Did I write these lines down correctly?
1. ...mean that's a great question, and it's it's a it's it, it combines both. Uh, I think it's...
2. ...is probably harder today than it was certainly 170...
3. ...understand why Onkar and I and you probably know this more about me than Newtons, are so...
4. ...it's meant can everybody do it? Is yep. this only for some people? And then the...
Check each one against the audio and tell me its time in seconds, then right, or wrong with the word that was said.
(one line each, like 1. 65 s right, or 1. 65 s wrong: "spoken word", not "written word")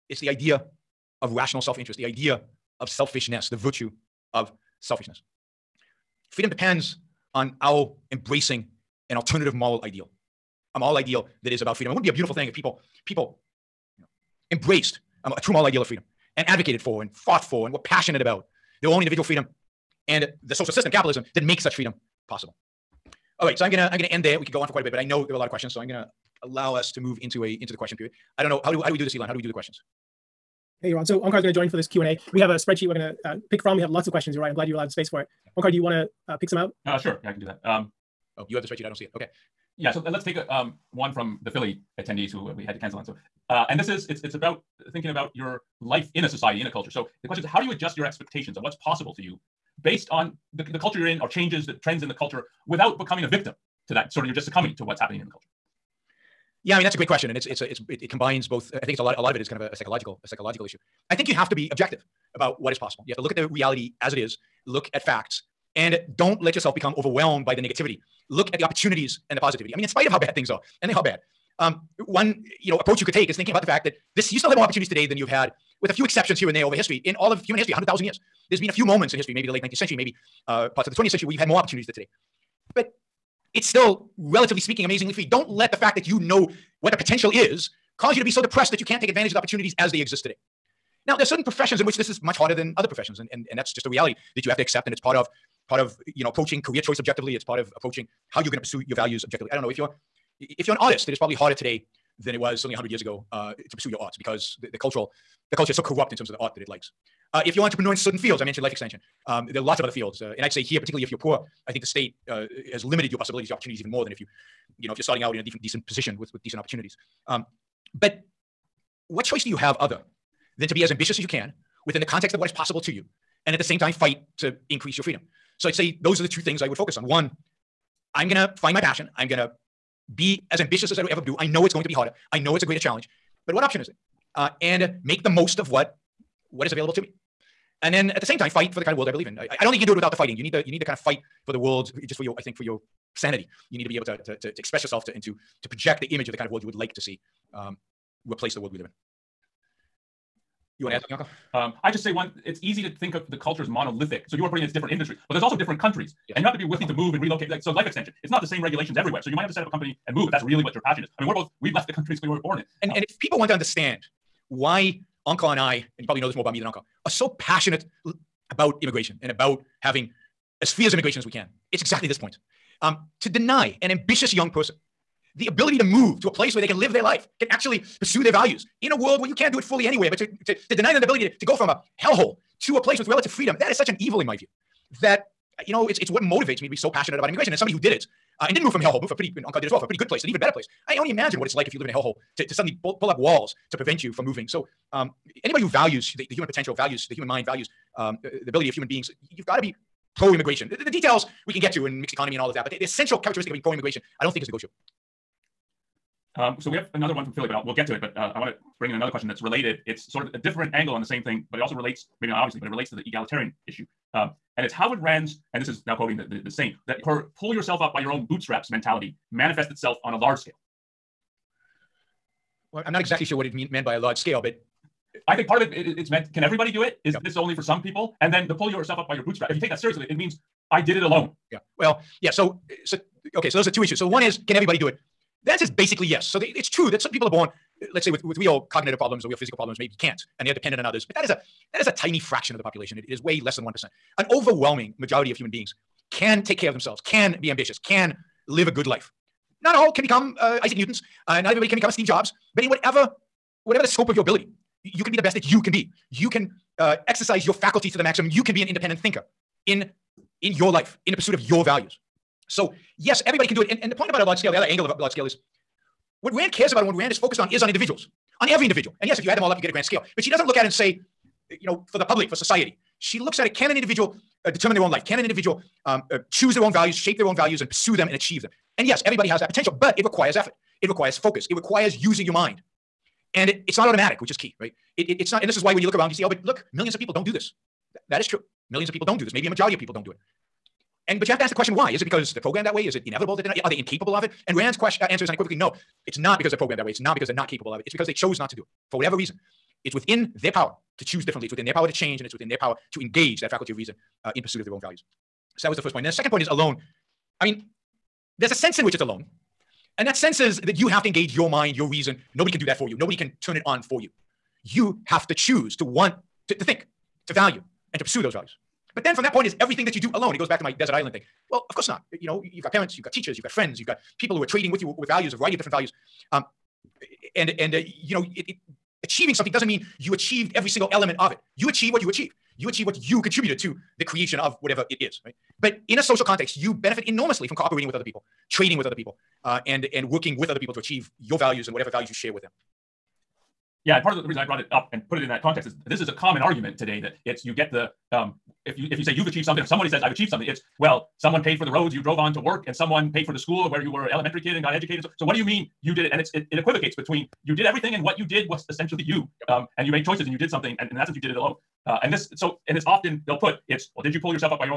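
1. 56 s right
2. 101 s wrong: "100", not "170"
3. 163 s wrong: "Onkar", not "Newtons"
4. 225 s right.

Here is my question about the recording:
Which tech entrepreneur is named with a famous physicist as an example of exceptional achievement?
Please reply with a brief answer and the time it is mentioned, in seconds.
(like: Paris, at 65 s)
Steve Jobs, at 251 s.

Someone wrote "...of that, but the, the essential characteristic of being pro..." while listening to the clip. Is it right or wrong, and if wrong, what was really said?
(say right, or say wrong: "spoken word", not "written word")
right.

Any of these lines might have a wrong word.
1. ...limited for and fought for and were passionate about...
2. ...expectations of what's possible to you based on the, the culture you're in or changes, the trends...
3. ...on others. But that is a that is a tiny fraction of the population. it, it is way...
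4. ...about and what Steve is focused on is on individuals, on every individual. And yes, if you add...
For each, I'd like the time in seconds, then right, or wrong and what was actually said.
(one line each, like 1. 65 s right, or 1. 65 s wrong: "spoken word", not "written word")
1. 16 s wrong: "advocated", not "limited"
2. 48 s right
3. 240 s right
4. 266 s wrong: "Rand", not "Steve".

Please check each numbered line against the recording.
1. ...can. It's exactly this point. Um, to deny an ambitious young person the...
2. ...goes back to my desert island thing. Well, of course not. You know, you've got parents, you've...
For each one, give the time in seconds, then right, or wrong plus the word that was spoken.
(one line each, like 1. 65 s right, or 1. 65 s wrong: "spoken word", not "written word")
1. 171 s right
2. 320 s right.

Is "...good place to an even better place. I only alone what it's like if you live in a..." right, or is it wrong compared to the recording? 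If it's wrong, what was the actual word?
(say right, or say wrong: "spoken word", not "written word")
wrong: "imagine", not "alone".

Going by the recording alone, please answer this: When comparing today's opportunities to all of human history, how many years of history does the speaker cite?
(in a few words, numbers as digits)
100,000 years.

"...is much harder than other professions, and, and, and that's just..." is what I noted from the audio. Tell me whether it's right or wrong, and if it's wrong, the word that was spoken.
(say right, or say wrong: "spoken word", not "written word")
right.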